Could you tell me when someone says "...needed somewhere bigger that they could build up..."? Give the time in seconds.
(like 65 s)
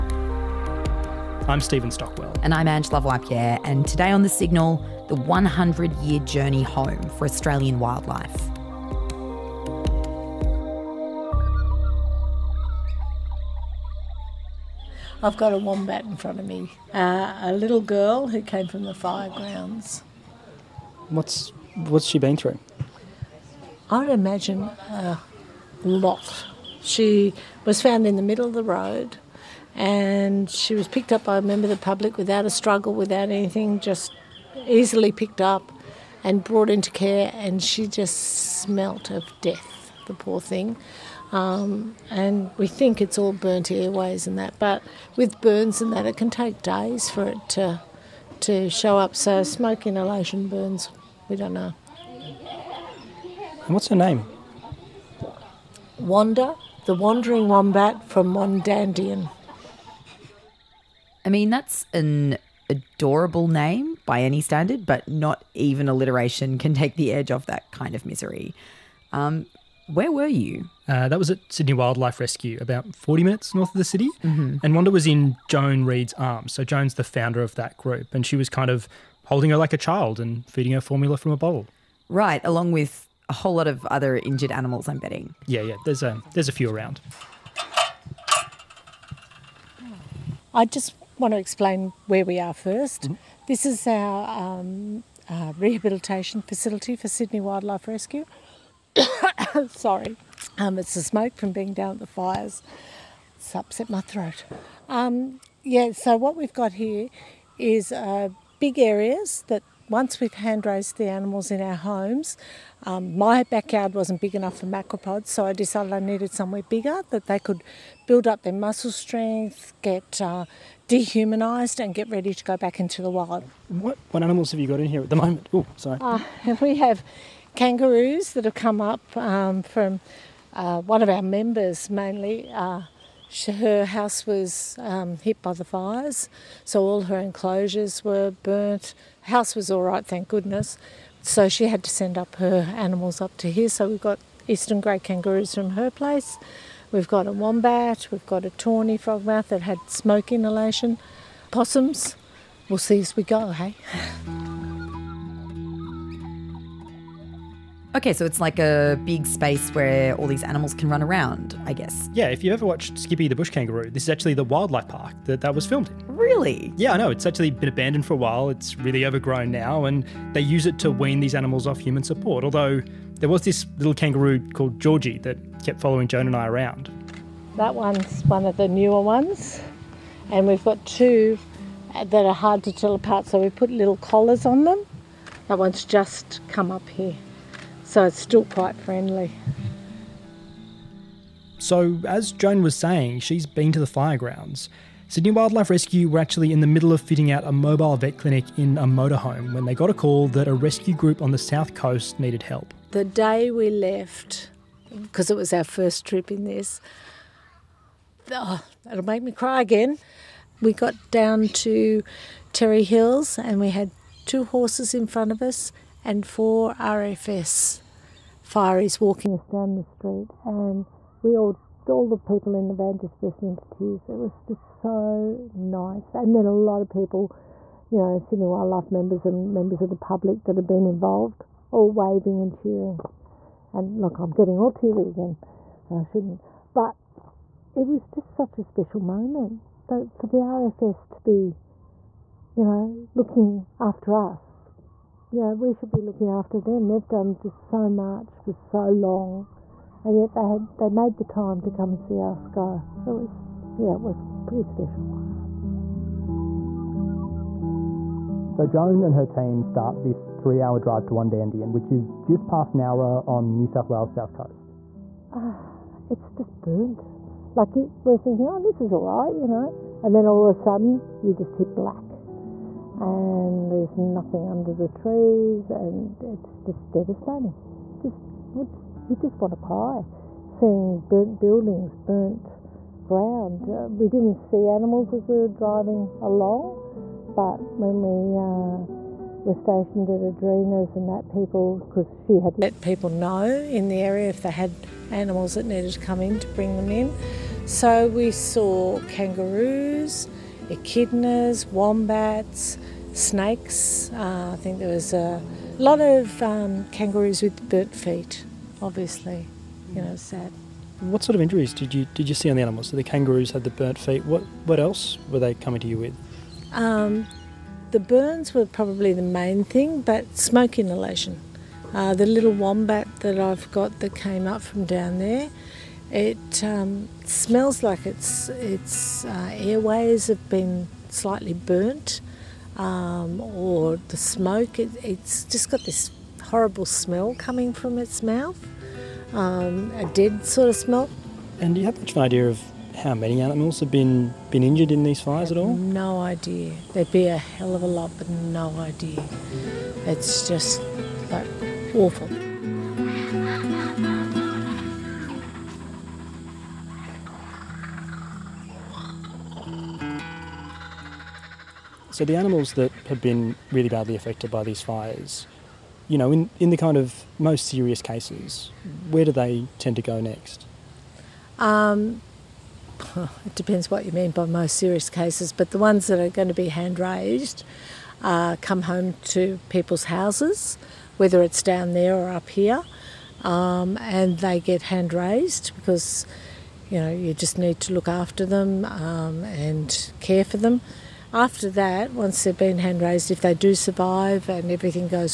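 115 s.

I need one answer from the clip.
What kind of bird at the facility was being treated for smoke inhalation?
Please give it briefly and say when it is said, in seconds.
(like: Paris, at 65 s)
Tawny frogmouth, at 148 s.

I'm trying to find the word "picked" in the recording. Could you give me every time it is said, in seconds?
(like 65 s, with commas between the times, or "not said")
30 s, 35 s.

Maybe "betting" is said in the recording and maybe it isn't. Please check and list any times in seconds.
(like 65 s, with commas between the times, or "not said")
84 s.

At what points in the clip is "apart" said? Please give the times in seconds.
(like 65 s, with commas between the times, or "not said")
182 s.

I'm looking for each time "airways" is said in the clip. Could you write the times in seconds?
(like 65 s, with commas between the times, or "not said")
43 s, 329 s.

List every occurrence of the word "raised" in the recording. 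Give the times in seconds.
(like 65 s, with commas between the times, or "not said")
110 s, 376 s, 385 s, 392 s.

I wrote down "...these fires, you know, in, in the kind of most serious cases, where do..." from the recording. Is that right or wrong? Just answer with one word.
right.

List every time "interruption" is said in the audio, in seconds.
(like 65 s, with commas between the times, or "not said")
not said.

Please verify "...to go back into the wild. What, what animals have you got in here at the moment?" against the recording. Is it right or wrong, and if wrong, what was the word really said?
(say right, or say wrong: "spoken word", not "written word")
right.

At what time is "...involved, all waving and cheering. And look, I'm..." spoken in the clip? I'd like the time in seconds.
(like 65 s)
230 s.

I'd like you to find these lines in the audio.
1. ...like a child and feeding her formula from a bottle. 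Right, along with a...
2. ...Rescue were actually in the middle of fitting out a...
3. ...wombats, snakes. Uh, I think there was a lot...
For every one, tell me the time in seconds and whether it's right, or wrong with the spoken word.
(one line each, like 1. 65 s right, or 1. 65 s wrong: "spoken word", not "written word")
1. 79 s right
2. 195 s right
3. 301 s right.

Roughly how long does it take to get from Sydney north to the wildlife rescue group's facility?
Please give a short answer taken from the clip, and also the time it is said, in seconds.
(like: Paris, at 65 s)
40 minutes, at 72 s.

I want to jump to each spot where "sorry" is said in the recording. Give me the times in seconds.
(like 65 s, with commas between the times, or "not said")
99 s, 125 s.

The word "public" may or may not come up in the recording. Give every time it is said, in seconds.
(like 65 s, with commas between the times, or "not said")
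31 s, 229 s.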